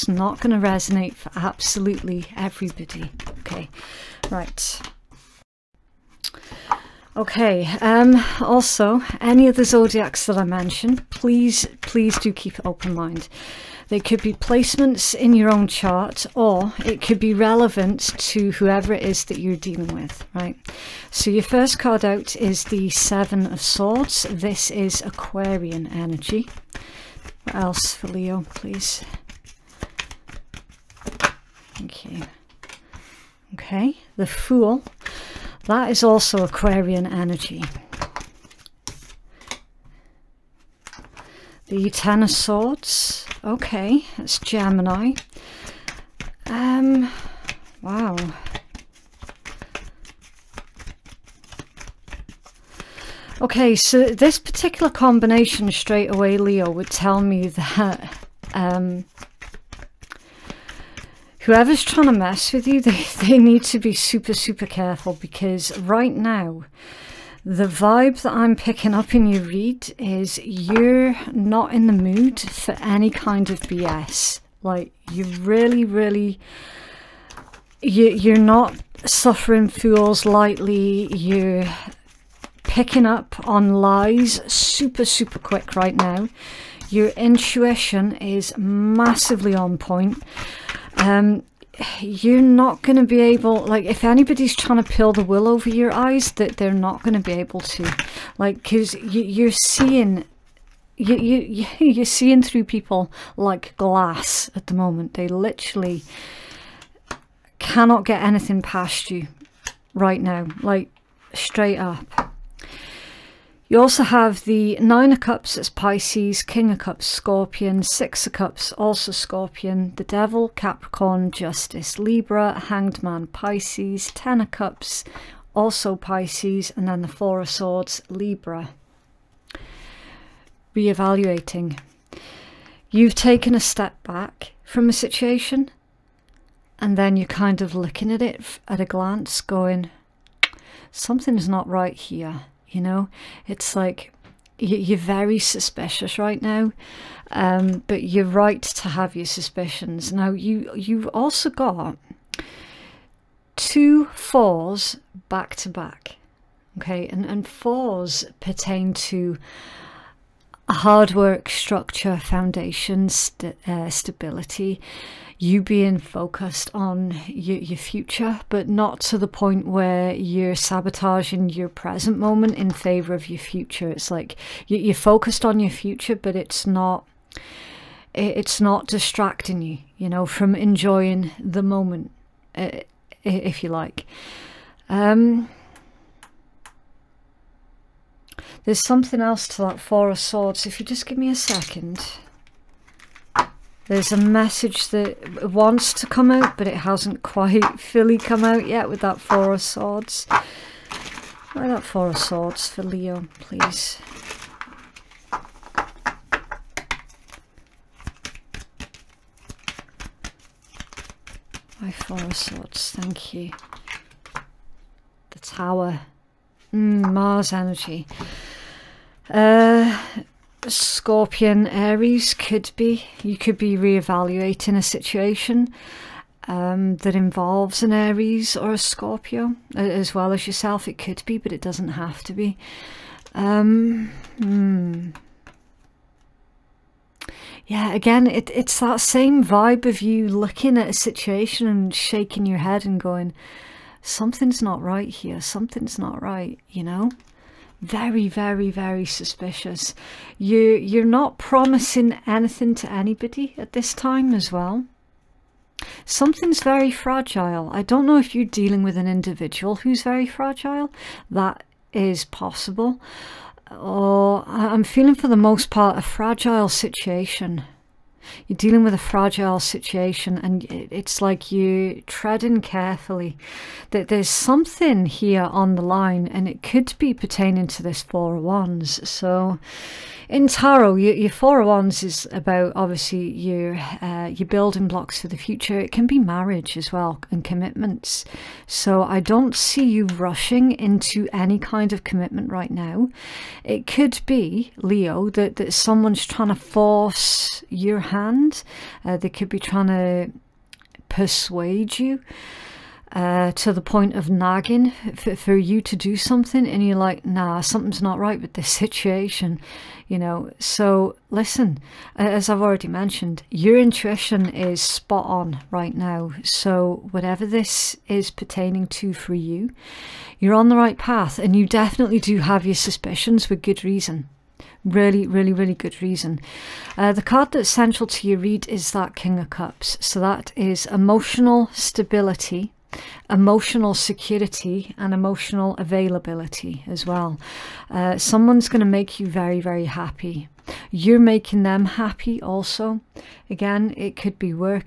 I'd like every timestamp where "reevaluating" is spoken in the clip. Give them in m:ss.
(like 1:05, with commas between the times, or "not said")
2:10, 3:43.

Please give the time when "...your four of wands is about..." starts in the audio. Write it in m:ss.
4:41.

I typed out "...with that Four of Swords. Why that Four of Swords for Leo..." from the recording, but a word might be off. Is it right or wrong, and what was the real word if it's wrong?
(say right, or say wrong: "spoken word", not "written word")
right.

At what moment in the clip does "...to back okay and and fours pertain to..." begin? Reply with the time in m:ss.
2:35.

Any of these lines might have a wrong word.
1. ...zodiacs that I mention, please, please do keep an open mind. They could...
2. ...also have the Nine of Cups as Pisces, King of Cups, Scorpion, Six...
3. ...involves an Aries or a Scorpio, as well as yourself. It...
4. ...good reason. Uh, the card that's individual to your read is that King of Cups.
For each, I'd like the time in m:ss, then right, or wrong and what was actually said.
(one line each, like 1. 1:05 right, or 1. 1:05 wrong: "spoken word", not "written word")
1. 0:09 right
2. 1:53 right
3. 3:47 right
4. 5:25 wrong: "central", not "individual".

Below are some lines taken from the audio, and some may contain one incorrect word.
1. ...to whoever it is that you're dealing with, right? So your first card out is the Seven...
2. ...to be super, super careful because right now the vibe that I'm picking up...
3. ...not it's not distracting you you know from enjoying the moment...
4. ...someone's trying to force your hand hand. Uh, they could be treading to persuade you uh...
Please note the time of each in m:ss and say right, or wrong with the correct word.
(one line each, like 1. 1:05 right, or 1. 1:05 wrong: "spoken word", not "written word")
1. 0:18 right
2. 1:03 right
3. 2:56 right
4. 4:55 wrong: "trying", not "treading".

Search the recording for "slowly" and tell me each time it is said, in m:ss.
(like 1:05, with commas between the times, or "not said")
not said.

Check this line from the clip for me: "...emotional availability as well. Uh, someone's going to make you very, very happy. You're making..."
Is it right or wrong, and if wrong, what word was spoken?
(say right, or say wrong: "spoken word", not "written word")
right.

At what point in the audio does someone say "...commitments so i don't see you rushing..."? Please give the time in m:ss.
4:47.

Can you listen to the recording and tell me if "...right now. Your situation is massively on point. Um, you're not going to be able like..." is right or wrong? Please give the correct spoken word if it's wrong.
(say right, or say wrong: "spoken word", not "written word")
wrong: "intuition", not "situation".